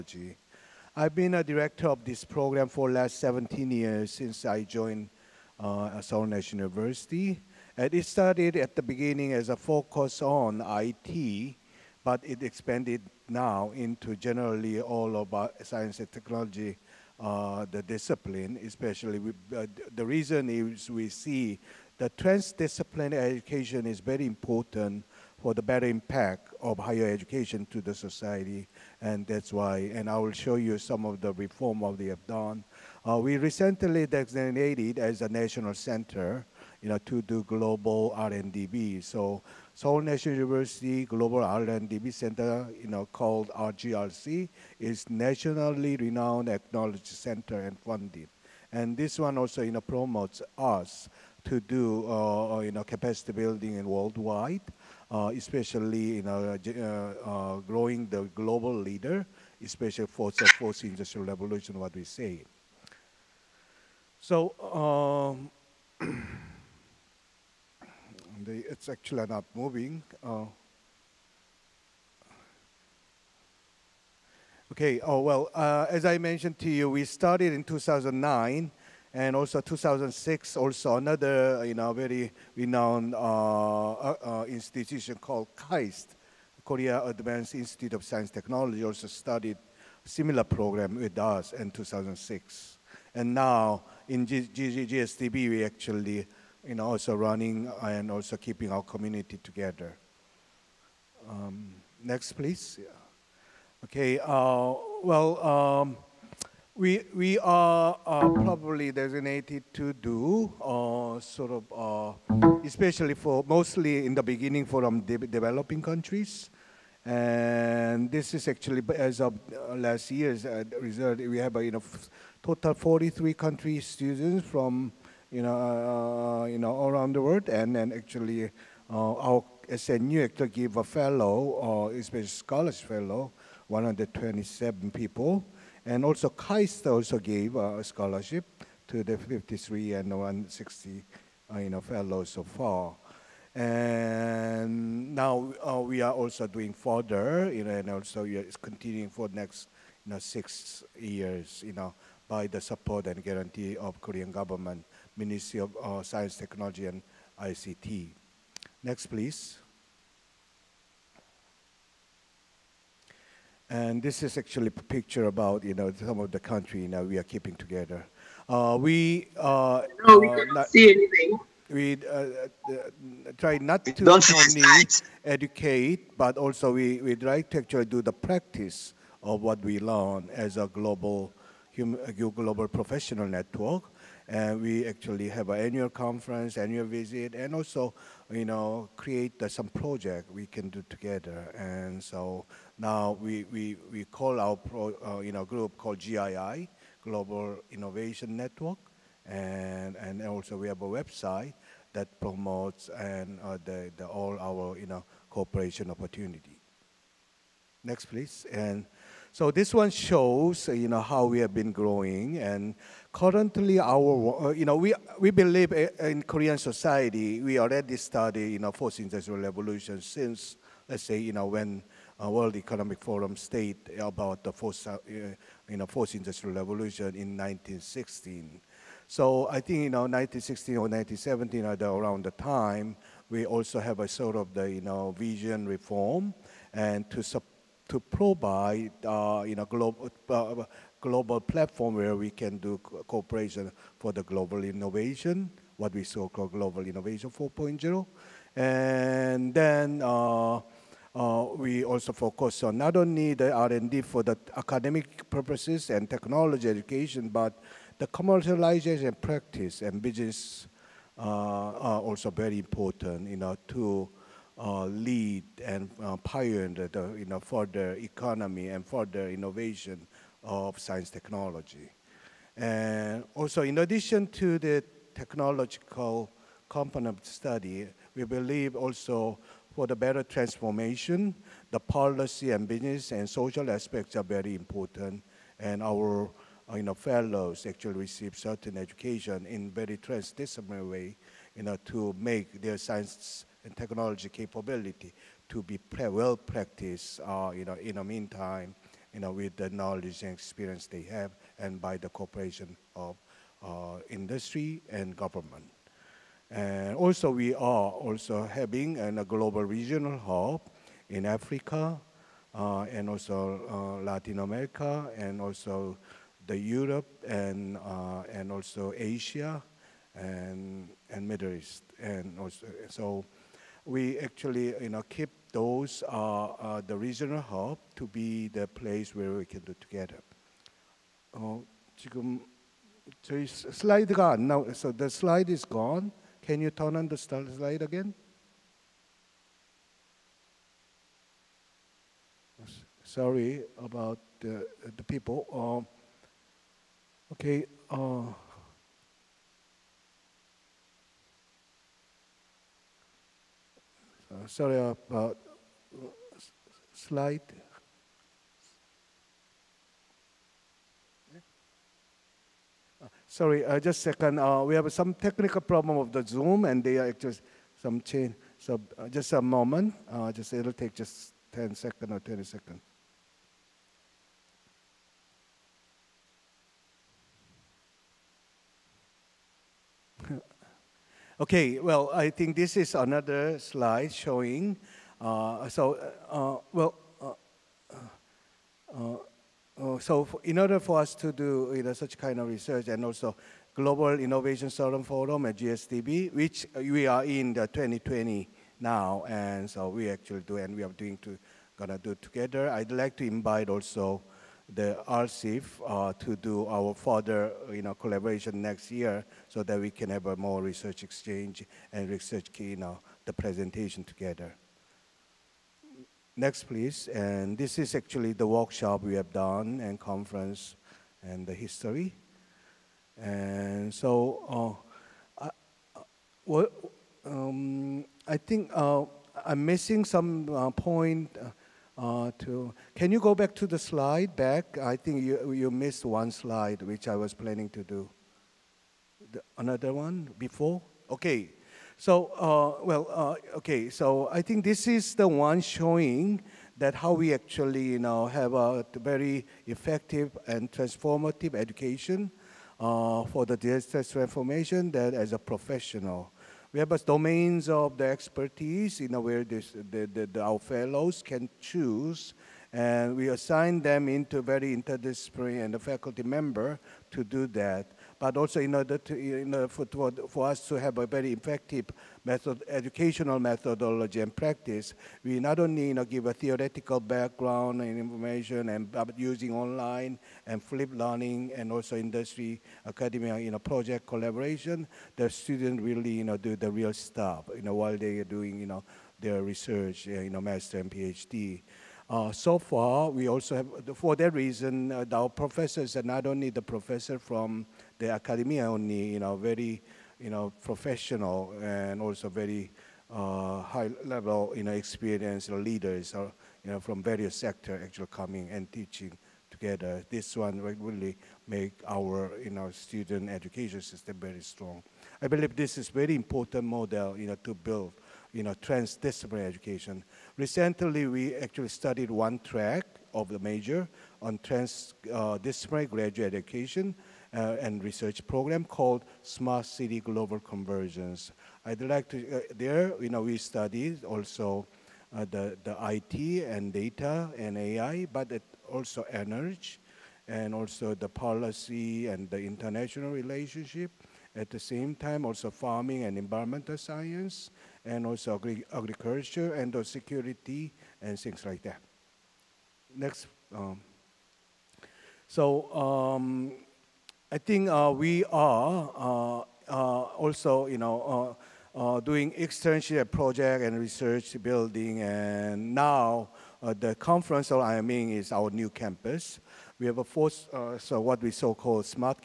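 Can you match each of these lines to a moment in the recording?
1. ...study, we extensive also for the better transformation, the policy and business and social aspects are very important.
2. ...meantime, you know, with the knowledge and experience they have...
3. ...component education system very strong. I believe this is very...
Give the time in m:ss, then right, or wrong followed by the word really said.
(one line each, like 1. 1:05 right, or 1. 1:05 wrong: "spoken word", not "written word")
1. 4:37 wrong: "believe", not "extensive"
2. 4:58 right
3. 8:32 wrong: "student", not "component".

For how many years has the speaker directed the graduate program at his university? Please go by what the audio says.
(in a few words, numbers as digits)
17 years.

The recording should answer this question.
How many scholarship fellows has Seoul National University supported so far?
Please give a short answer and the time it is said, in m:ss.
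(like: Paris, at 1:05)
127, at 2:13.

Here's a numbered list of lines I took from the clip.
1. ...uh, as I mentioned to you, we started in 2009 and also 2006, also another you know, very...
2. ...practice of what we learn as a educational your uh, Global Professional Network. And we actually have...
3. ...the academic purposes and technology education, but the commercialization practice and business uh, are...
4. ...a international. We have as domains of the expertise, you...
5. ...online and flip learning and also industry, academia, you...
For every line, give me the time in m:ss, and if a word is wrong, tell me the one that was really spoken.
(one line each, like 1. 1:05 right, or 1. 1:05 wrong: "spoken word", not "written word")
1. 1:15 right
2. 2:58 wrong: "global", not "educational"
3. 4:14 right
4. 7:35 wrong: "professional", not "international"
5. 7:59 right.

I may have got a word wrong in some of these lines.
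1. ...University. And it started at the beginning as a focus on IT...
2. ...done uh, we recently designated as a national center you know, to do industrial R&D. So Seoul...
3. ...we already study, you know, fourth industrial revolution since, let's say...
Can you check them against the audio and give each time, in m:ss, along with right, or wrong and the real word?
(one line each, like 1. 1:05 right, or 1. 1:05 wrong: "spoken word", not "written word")
1. 0:06 right
2. 0:32 wrong: "global", not "industrial"
3. 3:37 right.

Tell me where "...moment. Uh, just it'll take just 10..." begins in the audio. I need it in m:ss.
6:09.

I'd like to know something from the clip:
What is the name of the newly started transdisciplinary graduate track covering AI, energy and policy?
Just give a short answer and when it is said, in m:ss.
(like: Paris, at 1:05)
Smart City Global Convergence, at 8:49.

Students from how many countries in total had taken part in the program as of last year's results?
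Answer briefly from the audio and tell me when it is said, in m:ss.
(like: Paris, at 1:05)
43, at 2:02.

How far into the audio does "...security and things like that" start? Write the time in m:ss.
9:09.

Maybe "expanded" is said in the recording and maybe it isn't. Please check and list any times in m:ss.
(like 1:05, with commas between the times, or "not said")
0:12.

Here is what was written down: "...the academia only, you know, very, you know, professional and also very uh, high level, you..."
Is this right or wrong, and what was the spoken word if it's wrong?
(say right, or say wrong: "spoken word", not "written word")
right.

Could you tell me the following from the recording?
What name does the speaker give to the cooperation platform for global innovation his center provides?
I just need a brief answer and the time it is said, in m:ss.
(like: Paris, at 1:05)
Global Innovation 4.0, at 4:06.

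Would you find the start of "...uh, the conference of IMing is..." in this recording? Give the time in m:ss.
9:26.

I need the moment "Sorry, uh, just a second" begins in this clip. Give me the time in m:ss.
6:03.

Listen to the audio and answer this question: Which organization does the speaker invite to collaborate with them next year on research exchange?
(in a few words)
RSIF.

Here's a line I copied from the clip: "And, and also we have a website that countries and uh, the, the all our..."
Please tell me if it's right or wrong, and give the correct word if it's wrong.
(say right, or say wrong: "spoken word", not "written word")
wrong: "promotes", not "countries".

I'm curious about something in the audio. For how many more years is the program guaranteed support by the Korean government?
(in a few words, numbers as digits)
6 years.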